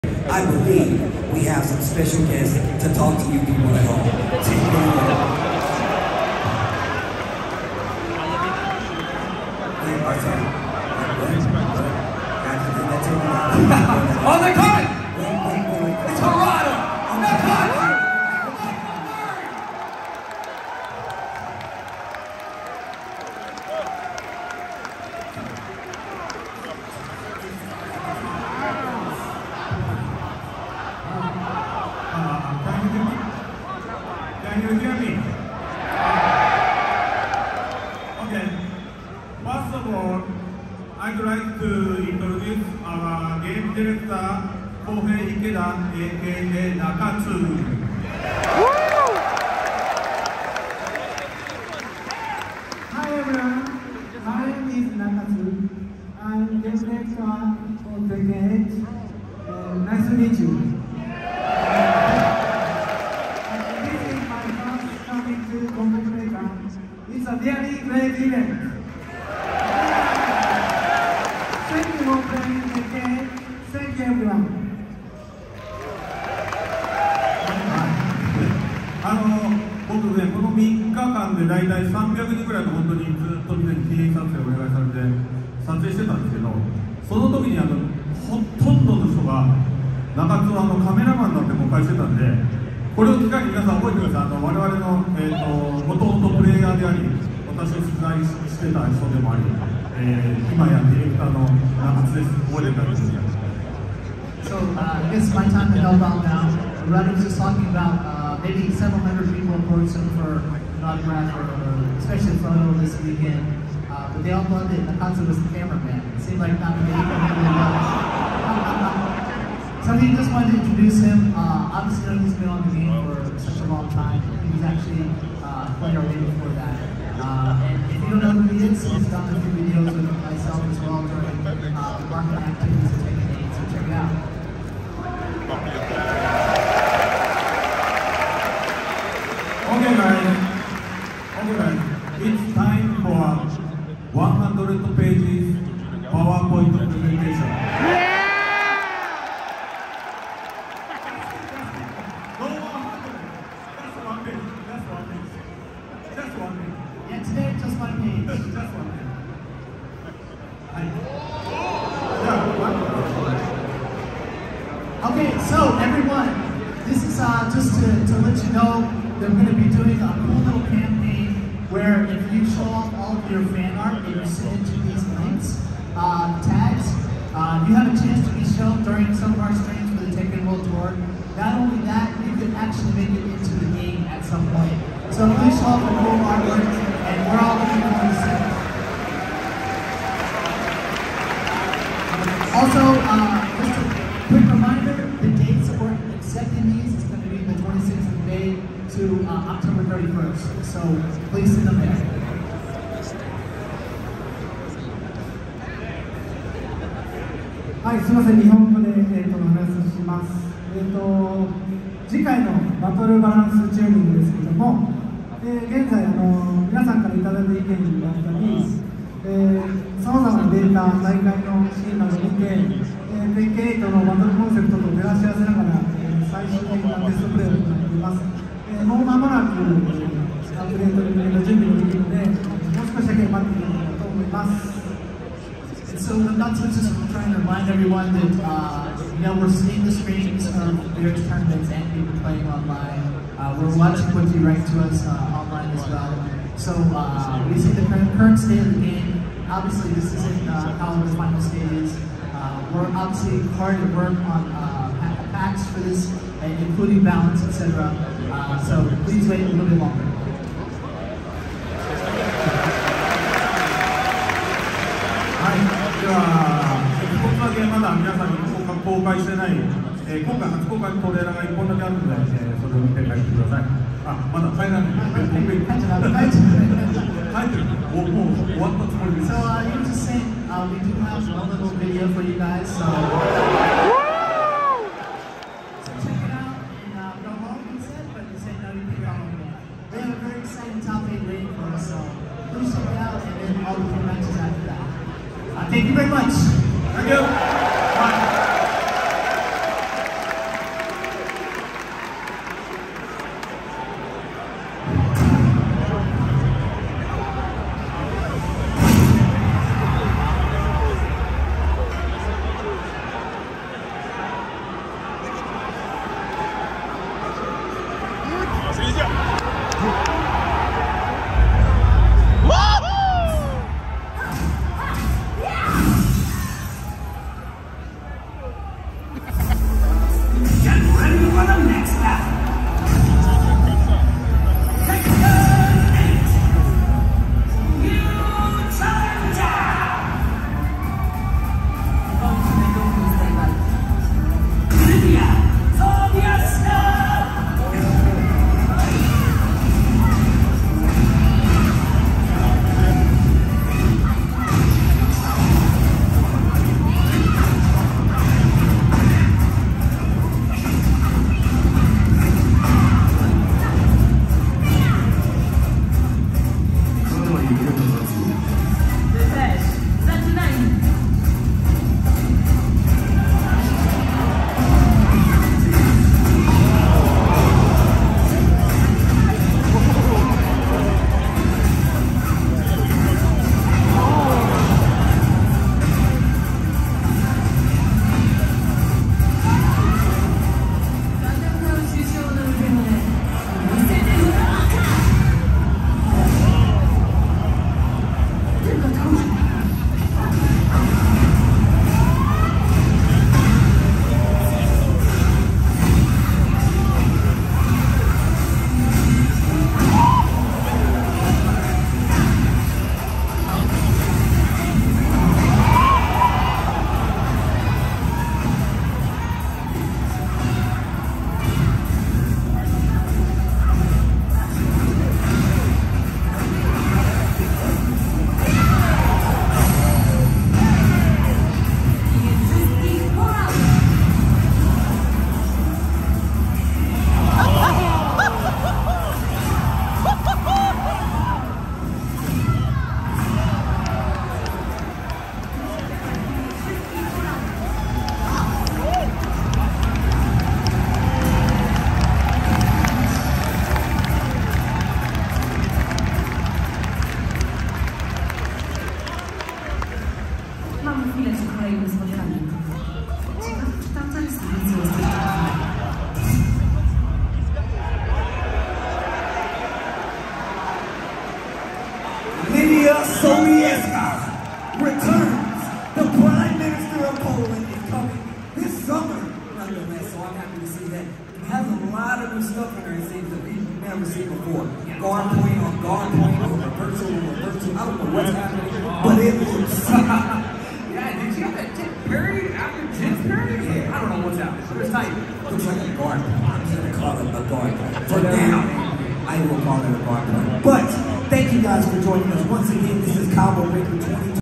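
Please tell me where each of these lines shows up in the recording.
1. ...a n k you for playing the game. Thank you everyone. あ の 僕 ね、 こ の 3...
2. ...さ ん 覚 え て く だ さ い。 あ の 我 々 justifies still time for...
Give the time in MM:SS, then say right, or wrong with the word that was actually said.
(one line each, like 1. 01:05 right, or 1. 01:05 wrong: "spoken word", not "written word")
1. 01:08 right
2. 01:33 right.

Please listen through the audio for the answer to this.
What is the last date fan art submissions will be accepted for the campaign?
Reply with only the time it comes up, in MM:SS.
03:19.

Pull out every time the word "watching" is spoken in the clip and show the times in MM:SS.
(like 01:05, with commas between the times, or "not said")
04:03.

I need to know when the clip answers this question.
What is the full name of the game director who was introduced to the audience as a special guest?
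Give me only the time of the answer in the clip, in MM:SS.
00:44.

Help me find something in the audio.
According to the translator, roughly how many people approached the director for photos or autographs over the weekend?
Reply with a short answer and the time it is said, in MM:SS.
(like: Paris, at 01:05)
several hundred, at 01:48.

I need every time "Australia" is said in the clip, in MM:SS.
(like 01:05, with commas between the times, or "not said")
not said.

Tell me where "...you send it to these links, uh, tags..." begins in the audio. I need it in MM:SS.
02:54.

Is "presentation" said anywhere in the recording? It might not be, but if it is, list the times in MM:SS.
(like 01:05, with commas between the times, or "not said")
02:26.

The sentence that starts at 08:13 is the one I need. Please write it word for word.
Yeah, I don't know what's happening, but it's tight.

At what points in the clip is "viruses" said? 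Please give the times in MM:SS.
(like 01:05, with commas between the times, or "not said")
not said.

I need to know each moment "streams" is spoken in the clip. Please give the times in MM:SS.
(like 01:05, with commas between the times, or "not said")
02:59, 03:59.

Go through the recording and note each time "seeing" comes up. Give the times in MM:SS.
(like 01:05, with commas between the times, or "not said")
03:59.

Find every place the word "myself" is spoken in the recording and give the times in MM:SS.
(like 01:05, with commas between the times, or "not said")
02:10.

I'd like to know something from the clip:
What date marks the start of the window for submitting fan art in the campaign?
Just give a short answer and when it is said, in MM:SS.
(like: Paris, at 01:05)
26th of May, at 03:17.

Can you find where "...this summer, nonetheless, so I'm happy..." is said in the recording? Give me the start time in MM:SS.
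07:58.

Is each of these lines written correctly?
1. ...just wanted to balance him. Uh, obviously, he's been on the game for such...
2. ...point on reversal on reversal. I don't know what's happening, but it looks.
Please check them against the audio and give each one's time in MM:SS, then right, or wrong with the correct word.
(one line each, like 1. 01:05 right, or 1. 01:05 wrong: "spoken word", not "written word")
1. 02:00 wrong: "introduce", not "balance"
2. 08:06 right.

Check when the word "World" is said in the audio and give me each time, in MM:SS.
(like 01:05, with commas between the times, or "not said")
03:00.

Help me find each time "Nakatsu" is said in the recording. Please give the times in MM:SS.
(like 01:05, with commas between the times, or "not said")
00:46, 01:54.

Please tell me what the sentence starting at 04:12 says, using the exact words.
Uh, we're obviously hard at work on packs uh, for this, including balance, etc.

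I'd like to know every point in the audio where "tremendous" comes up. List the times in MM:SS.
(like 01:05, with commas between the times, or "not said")
not said.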